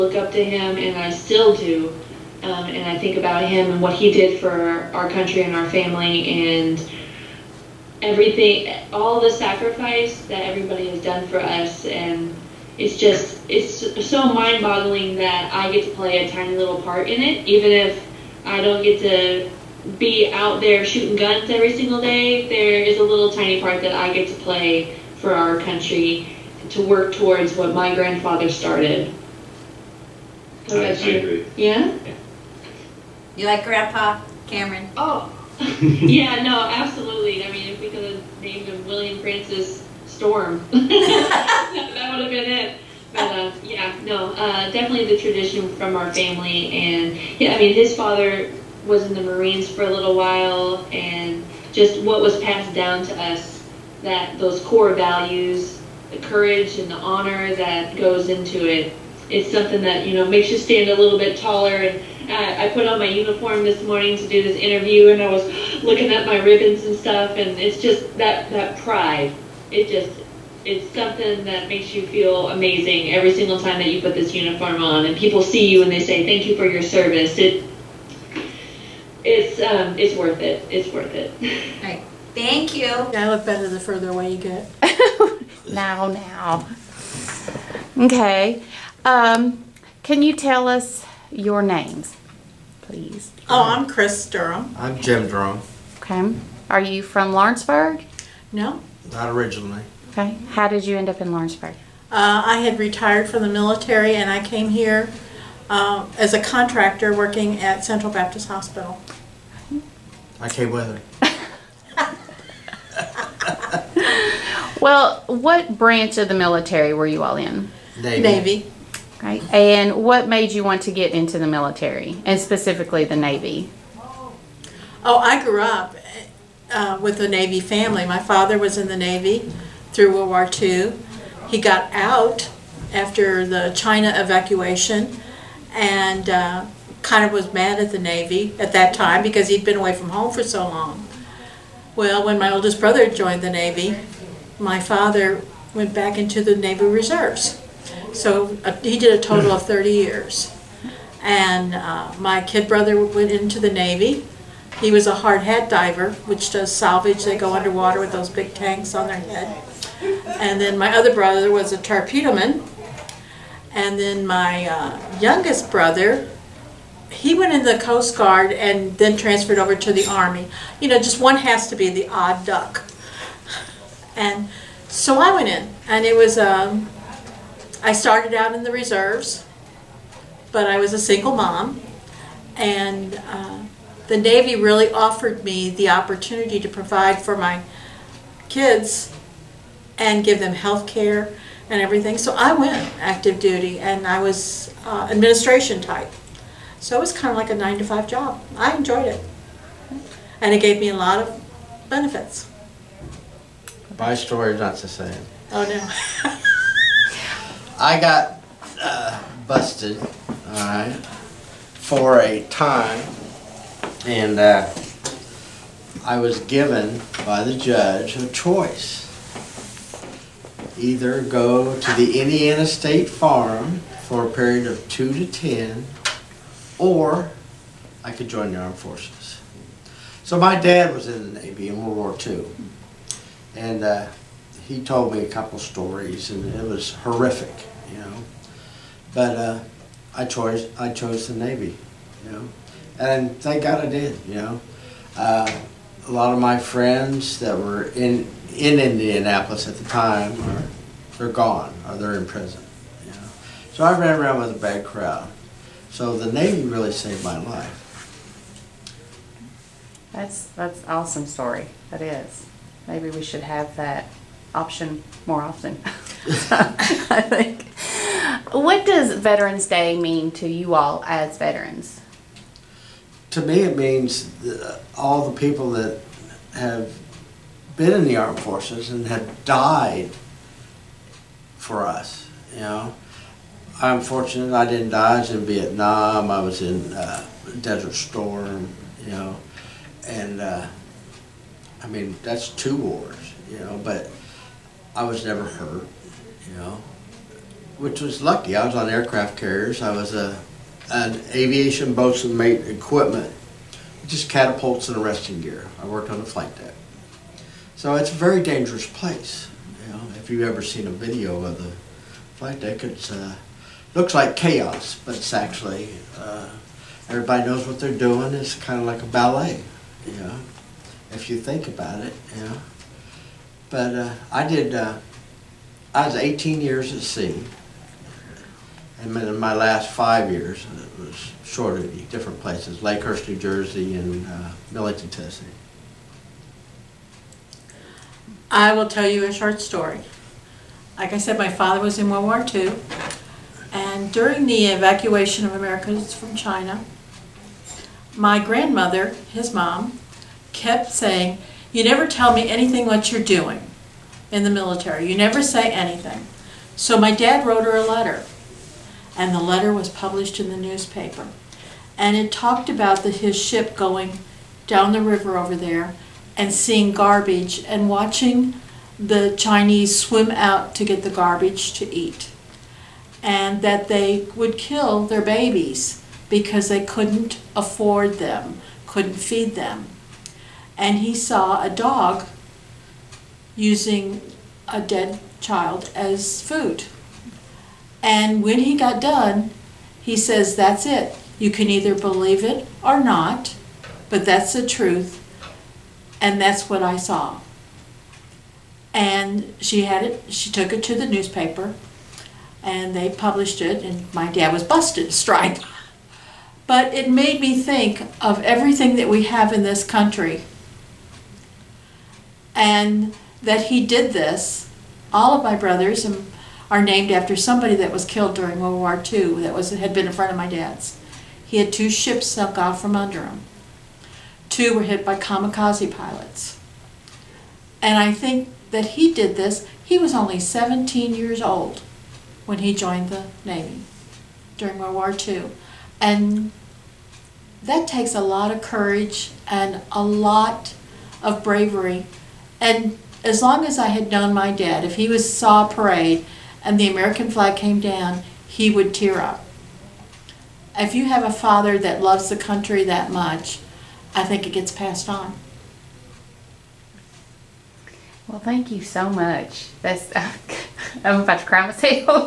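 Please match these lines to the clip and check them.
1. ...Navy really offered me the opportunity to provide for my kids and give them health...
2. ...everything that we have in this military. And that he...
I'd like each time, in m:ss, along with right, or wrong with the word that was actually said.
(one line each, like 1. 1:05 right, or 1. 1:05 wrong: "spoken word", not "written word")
1. 3:04 right
2. 6:48 wrong: "country", not "military".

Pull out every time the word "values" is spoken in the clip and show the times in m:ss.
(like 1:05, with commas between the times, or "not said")
0:54.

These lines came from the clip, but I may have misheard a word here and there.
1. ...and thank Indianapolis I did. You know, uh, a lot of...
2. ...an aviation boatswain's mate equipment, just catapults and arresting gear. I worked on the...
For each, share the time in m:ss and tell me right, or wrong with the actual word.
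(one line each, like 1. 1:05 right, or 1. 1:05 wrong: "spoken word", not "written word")
1. 4:03 wrong: "God", not "Indianapolis"
2. 5:00 right.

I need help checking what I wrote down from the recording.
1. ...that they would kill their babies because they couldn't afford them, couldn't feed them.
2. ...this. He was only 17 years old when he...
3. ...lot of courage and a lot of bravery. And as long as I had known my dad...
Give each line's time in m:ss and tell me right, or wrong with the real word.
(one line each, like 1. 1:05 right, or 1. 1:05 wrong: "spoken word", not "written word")
1. 6:13 right
2. 7:09 right
3. 7:18 right.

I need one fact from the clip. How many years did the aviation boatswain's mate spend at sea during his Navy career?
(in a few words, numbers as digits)
18.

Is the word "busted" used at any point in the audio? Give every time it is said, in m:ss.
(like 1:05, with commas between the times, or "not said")
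3:29, 6:44.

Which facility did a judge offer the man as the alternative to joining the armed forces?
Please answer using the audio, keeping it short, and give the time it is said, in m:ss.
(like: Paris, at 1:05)
Indiana State Farm, at 3:42.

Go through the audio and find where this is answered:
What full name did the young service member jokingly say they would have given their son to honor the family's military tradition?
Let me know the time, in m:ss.
0:38.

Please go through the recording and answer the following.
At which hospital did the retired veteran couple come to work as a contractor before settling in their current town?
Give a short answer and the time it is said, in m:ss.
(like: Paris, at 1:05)
Central Baptist Hospital, at 1:47.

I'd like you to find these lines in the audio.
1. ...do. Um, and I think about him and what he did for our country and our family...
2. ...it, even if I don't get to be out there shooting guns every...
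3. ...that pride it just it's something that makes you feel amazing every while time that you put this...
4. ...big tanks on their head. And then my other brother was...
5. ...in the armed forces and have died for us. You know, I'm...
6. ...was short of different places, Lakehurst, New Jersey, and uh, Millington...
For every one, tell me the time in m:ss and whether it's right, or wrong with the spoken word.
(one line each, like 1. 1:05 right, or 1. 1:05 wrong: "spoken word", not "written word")
1. 0:01 right
2. 0:17 right
3. 1:08 wrong: "single", not "while"
4. 2:38 right
5. 4:37 right
6. 5:31 right.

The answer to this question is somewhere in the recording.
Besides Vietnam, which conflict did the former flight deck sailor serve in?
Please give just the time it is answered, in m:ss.
4:47.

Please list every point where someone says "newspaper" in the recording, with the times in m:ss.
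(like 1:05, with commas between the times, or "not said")
6:00, 6:41.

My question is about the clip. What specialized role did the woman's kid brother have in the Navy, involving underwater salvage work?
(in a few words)
Hard hat diver.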